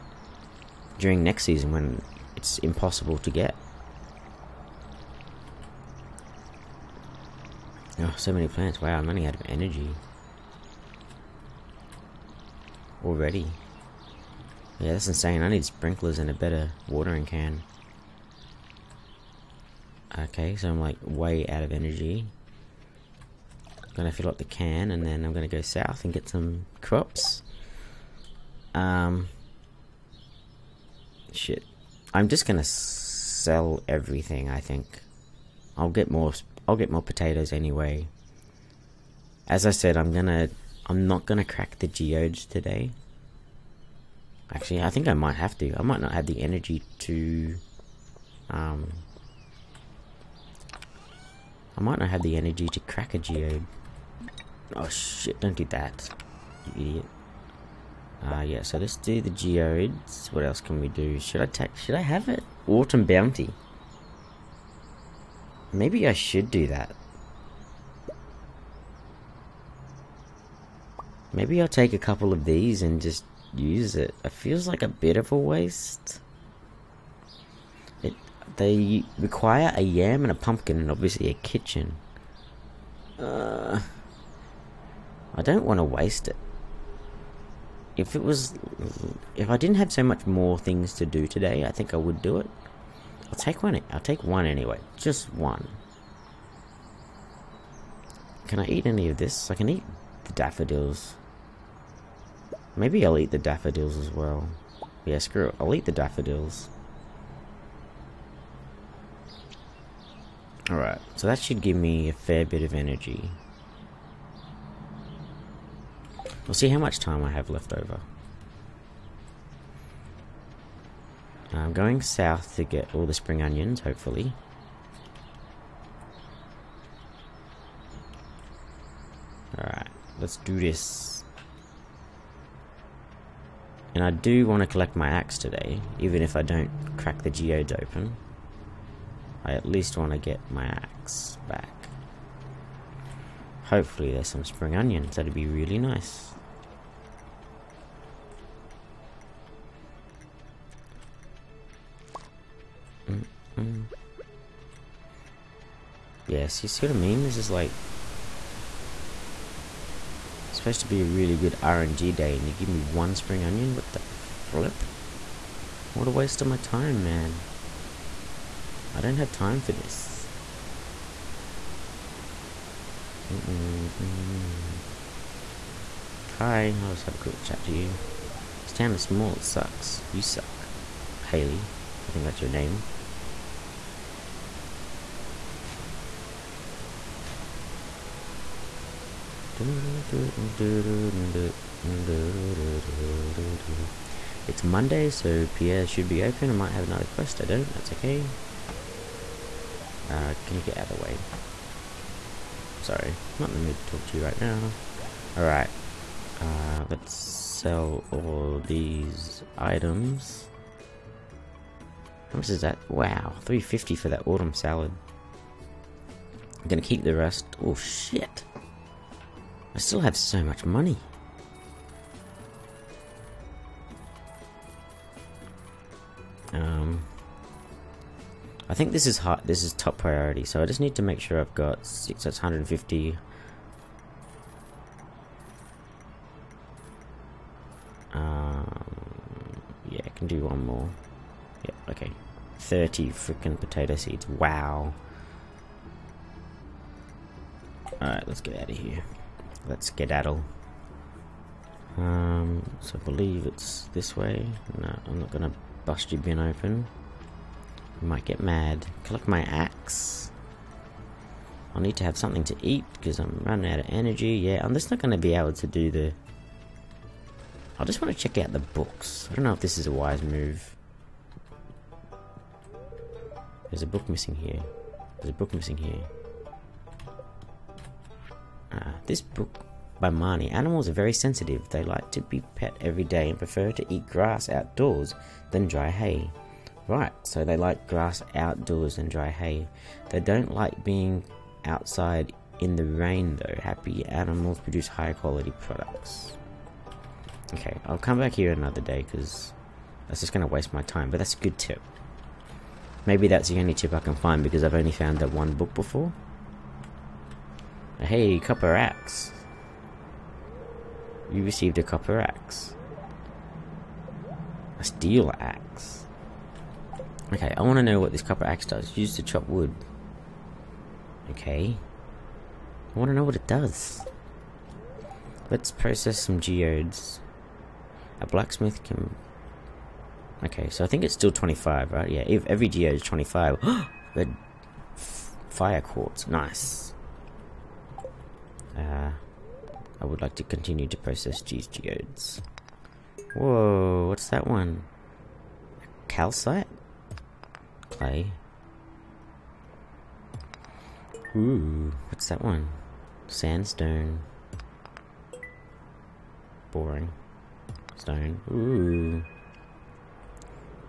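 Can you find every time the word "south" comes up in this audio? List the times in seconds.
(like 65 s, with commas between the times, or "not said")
25 s, 122 s.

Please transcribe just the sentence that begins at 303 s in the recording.
Maybe that's the only tip I can find because I've only found that one book before.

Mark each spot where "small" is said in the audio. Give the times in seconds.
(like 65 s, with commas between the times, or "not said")
179 s.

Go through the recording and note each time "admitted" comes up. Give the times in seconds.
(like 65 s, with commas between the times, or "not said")
not said.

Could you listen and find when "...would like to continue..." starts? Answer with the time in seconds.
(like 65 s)
340 s.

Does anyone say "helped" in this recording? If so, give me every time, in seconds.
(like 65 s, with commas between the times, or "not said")
not said.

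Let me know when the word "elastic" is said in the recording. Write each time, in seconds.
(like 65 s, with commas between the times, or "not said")
not said.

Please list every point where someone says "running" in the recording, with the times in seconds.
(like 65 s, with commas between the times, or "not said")
9 s, 263 s.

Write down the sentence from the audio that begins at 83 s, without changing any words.
Uh, I don't want to waste it.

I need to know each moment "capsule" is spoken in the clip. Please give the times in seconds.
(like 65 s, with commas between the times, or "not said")
not said.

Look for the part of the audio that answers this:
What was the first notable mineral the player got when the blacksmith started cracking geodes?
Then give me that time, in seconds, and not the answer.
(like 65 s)
335 s.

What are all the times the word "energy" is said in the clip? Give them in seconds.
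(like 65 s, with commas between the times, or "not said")
9 s, 21 s, 46 s, 52 s, 112 s, 263 s.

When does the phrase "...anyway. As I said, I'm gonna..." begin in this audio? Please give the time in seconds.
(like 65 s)
37 s.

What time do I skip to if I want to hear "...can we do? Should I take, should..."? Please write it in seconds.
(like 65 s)
60 s.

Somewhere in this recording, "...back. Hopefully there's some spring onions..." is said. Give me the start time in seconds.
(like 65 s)
141 s.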